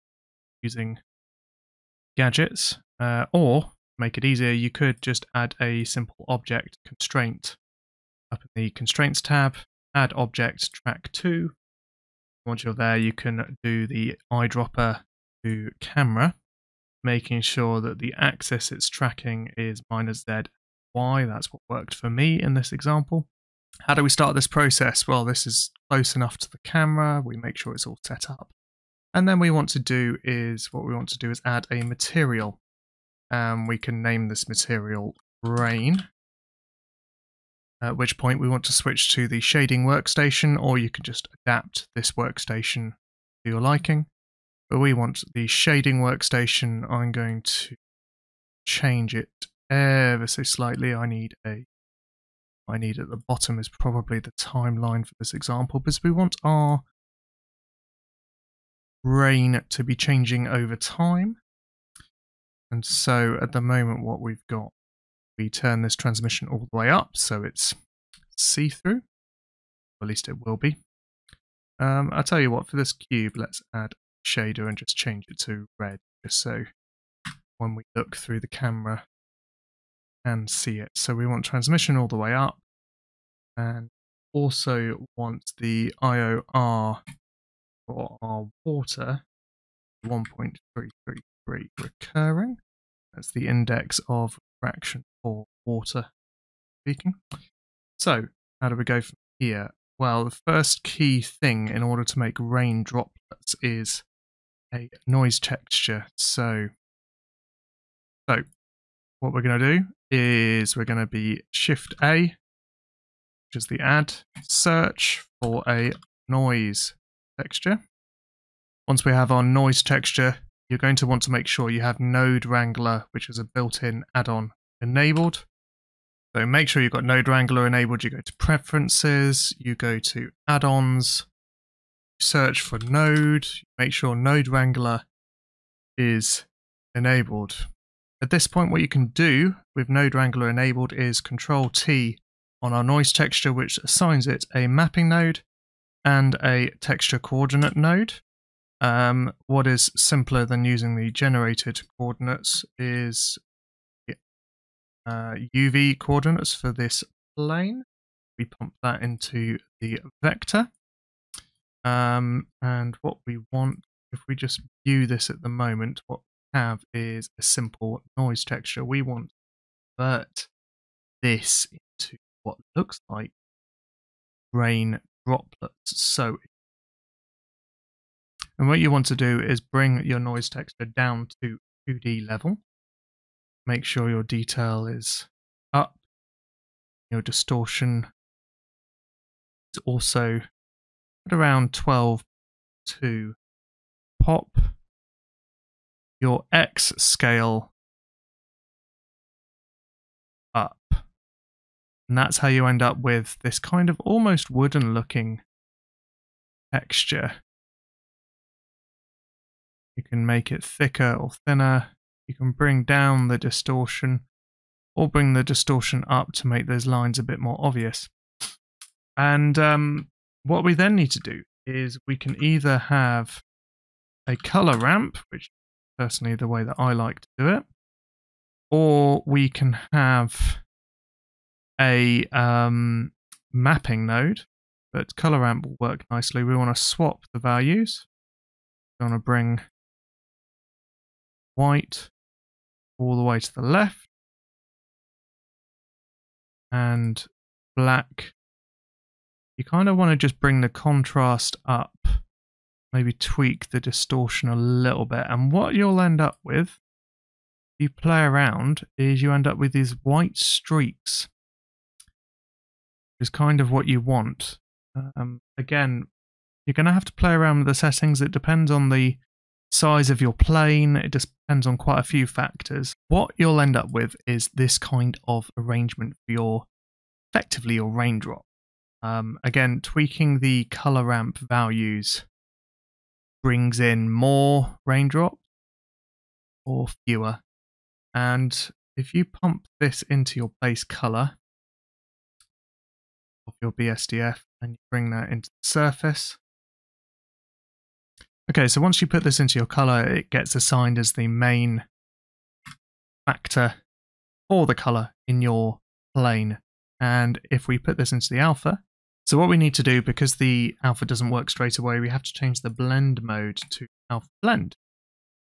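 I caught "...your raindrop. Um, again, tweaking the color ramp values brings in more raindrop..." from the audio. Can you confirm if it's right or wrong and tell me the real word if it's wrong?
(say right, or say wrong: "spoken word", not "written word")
right.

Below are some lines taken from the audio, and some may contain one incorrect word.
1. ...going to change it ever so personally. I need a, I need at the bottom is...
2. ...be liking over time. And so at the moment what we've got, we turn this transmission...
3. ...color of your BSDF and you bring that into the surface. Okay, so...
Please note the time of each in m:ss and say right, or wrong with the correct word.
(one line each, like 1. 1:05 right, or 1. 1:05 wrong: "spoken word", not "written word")
1. 0:47 wrong: "slightly", not "personally"
2. 0:59 wrong: "changing", not "liking"
3. 4:50 right.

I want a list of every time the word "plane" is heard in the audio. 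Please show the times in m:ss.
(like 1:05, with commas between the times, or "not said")
2:37, 4:30, 5:06.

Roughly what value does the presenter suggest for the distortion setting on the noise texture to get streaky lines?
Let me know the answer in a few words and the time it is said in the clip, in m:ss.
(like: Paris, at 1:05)
12, at 3:11.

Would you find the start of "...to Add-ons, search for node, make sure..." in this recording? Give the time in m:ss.
2:09.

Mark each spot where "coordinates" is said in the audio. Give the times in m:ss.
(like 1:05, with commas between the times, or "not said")
2:27, 2:31, 2:35.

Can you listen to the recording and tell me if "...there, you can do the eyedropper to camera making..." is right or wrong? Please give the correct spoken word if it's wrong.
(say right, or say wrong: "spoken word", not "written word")
right.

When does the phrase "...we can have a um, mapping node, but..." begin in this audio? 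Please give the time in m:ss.
3:49.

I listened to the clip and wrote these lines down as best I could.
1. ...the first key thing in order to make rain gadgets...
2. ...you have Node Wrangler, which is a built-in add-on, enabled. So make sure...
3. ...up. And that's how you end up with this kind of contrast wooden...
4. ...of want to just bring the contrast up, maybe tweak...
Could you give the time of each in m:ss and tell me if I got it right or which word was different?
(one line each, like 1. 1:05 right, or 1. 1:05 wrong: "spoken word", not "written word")
1. 1:40 wrong: "droplets", not "gadgets"
2. 2:01 right
3. 3:20 wrong: "almost", not "contrast"
4. 4:09 right.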